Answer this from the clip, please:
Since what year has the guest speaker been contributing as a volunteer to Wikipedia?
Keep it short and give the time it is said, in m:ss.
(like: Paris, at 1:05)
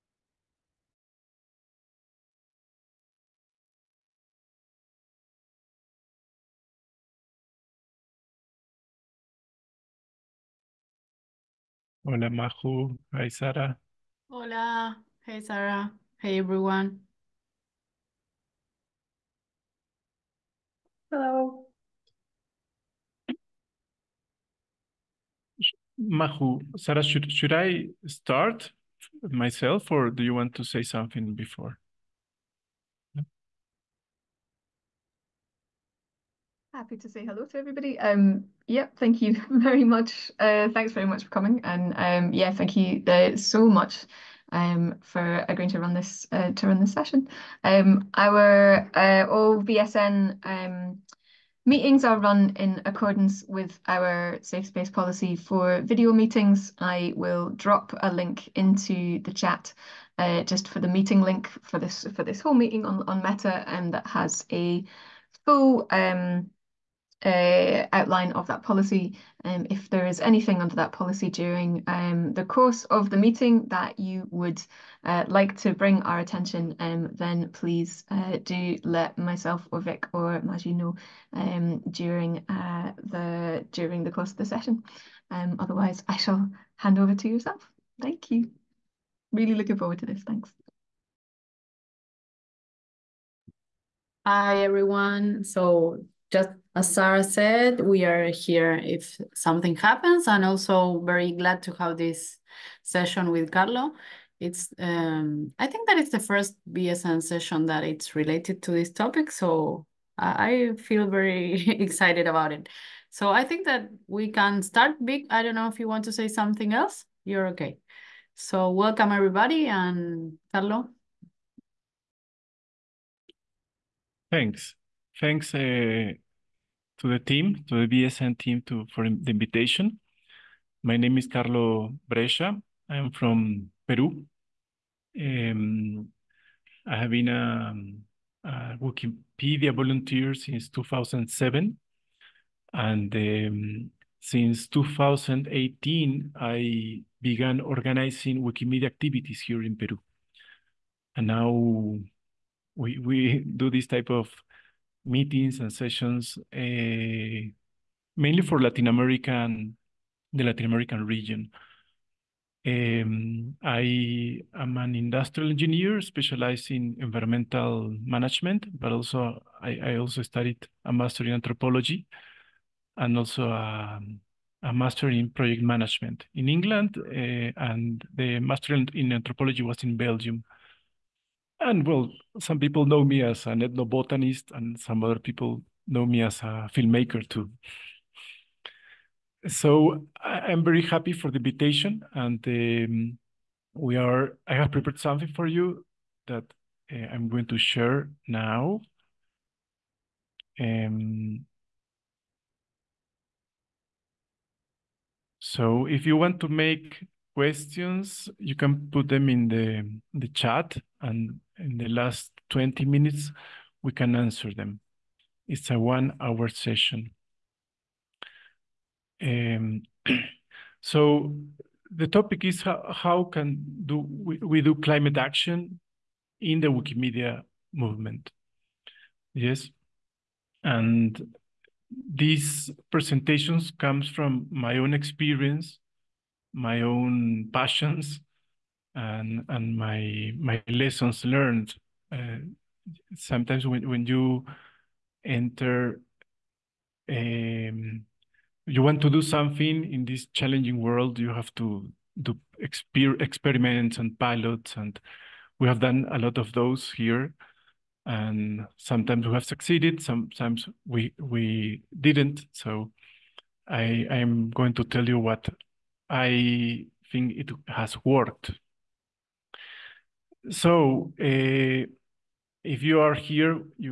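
2007, at 2:20.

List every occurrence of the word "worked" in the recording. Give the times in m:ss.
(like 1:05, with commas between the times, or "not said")
4:28.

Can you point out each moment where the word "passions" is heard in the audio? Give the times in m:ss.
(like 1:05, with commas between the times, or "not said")
3:57.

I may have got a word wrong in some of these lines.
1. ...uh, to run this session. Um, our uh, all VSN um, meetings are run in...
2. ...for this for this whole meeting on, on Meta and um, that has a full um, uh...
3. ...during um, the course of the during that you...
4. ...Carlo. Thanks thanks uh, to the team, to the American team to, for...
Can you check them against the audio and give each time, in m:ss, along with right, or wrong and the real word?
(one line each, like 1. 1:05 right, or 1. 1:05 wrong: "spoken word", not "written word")
1. 0:46 right
2. 1:01 right
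3. 1:11 wrong: "meeting", not "during"
4. 2:00 wrong: "VSN", not "American".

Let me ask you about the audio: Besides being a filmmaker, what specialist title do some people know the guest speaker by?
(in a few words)
ethnobotanist.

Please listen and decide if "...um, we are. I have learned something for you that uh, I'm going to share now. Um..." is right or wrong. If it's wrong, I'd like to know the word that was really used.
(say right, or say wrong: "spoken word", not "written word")
wrong: "prepared", not "learned".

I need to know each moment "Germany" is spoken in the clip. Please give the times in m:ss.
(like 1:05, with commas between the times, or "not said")
not said.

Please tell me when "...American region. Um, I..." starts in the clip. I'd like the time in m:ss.
2:40.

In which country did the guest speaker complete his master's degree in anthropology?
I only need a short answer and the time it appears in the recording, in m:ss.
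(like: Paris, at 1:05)
Belgium, at 2:59.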